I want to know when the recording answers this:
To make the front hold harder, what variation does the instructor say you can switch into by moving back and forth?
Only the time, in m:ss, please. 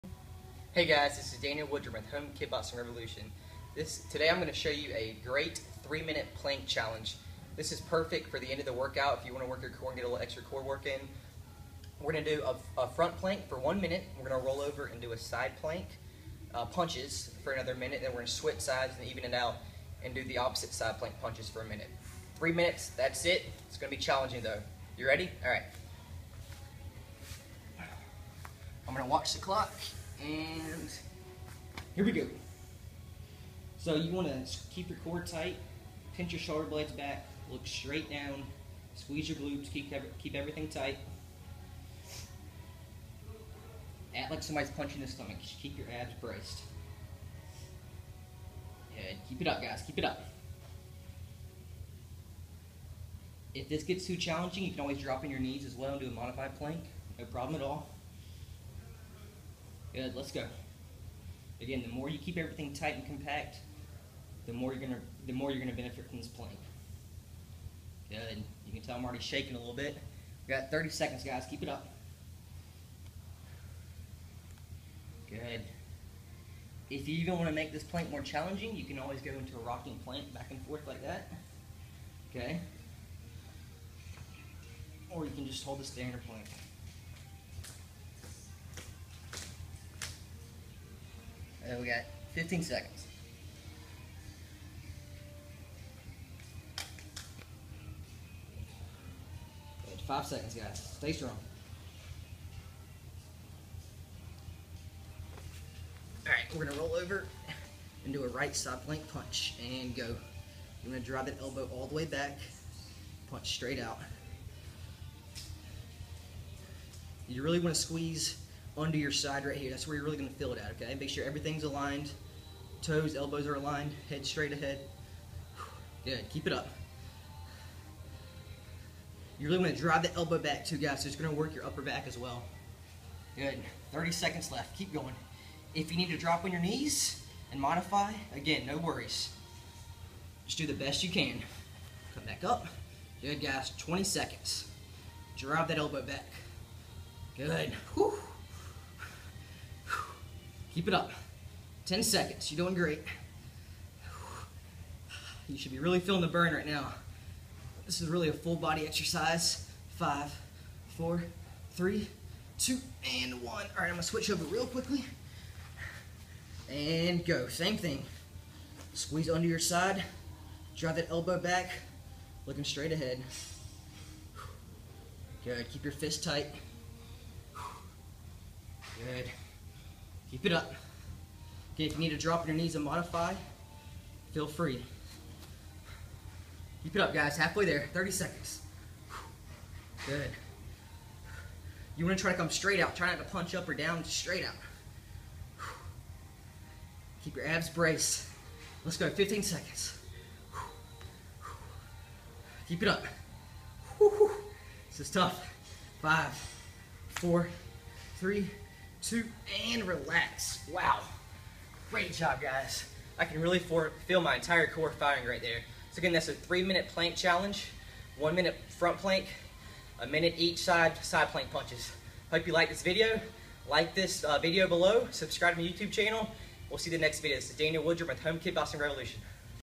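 1:19.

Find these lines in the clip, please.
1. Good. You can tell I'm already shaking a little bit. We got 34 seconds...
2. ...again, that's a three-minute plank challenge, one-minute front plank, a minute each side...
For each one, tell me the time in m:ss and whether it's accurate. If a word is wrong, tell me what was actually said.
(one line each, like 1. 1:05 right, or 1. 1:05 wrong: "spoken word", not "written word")
1. 1:08 wrong: "30", not "34"
2. 3:35 right.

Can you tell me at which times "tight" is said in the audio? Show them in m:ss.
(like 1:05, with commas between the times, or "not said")
0:35, 0:40, 1:02, 2:56.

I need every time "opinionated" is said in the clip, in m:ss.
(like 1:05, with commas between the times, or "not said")
not said.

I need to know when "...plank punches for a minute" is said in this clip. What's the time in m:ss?
0:20.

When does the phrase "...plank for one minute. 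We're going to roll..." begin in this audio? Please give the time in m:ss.
0:13.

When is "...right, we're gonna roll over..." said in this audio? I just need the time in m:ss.
1:46.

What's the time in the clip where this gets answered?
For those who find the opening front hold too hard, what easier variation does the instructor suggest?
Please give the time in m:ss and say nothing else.
0:56.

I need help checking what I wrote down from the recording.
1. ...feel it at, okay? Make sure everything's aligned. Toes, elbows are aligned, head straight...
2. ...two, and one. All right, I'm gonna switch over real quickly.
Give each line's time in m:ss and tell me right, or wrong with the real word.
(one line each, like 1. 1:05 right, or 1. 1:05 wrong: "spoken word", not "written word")
1. 2:00 right
2. 2:42 right.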